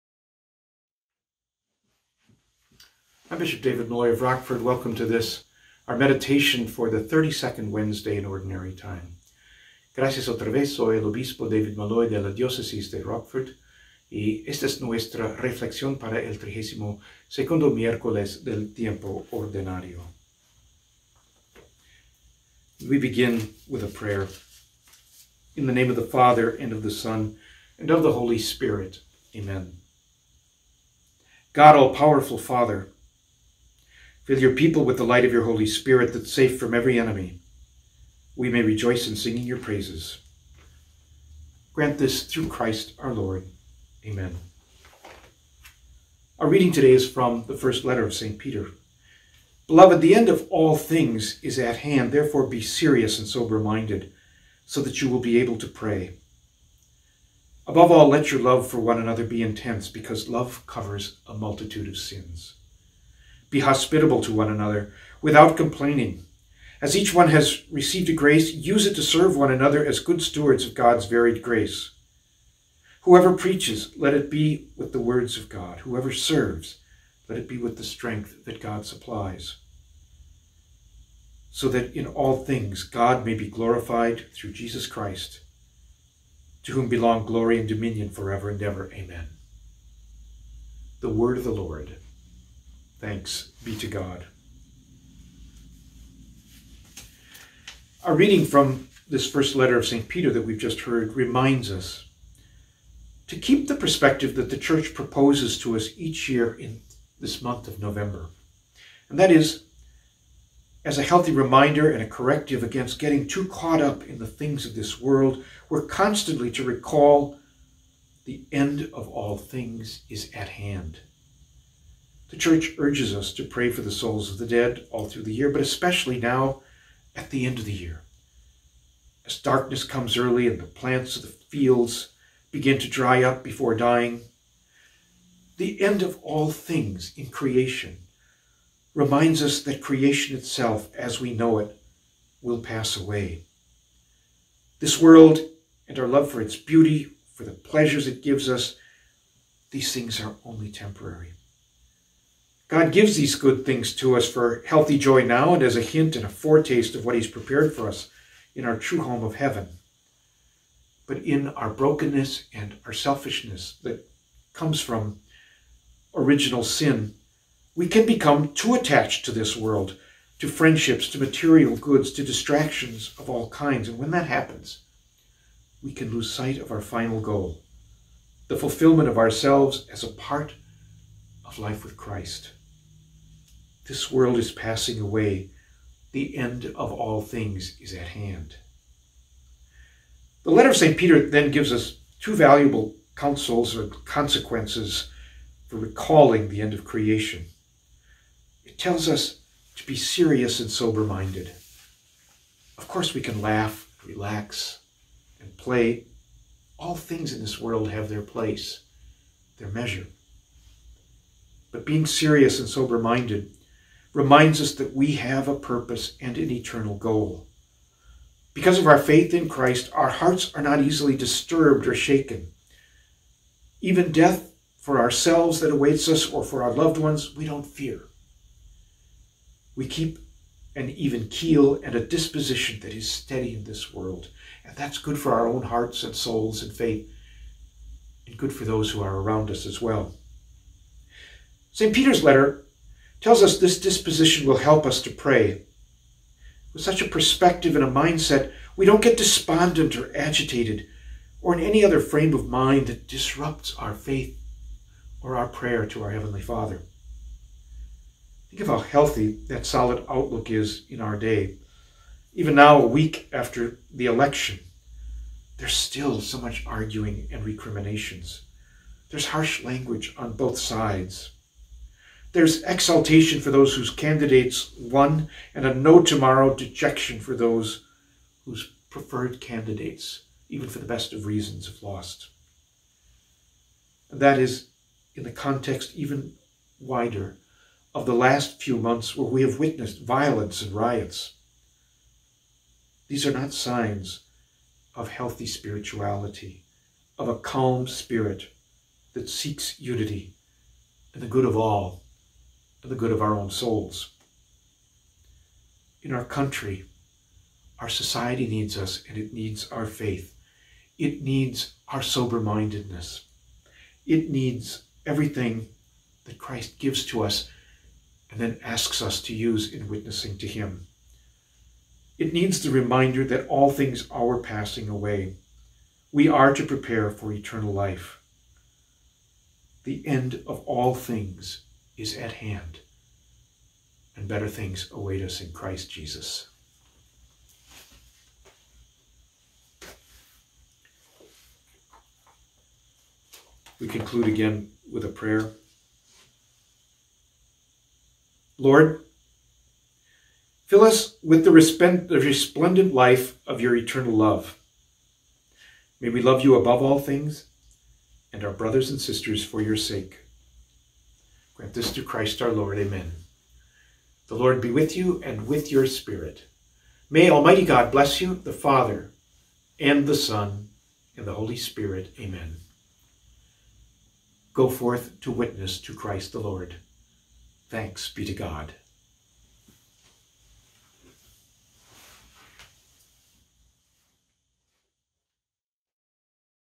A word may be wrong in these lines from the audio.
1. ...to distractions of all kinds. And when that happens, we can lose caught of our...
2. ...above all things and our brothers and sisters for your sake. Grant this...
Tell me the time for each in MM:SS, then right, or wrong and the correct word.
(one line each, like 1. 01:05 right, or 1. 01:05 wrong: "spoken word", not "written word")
1. 02:52 wrong: "sight", not "caught"
2. 05:56 right.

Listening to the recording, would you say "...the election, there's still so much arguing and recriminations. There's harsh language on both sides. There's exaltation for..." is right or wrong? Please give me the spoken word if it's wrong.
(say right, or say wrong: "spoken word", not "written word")
right.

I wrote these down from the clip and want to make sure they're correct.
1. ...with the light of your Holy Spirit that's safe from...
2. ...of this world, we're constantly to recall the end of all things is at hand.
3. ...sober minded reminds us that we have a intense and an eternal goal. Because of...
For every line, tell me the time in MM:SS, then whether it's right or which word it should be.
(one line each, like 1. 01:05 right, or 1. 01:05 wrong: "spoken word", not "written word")
1. 00:34 right
2. 01:54 right
3. 03:32 wrong: "purpose", not "intense".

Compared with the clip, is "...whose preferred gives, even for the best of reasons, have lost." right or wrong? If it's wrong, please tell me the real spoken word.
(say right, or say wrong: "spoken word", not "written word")
wrong: "candidates", not "gives".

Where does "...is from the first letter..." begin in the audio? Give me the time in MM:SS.
00:46.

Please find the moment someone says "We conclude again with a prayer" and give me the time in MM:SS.
05:43.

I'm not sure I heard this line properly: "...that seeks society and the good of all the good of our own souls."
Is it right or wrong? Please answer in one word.
wrong.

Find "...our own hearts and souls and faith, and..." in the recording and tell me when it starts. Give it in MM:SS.
03:55.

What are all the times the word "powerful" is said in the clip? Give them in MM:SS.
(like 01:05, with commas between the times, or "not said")
00:31.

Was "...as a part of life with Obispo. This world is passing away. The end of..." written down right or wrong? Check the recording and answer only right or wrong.
wrong.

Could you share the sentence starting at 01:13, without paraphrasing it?
Whoever preaches, let it be with the words of God.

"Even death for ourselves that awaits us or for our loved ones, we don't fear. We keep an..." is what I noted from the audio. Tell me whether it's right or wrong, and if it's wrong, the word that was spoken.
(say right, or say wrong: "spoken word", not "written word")
right.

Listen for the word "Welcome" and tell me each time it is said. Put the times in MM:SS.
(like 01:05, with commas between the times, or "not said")
00:04.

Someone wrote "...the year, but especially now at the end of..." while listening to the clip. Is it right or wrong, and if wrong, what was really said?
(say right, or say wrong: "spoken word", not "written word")
right.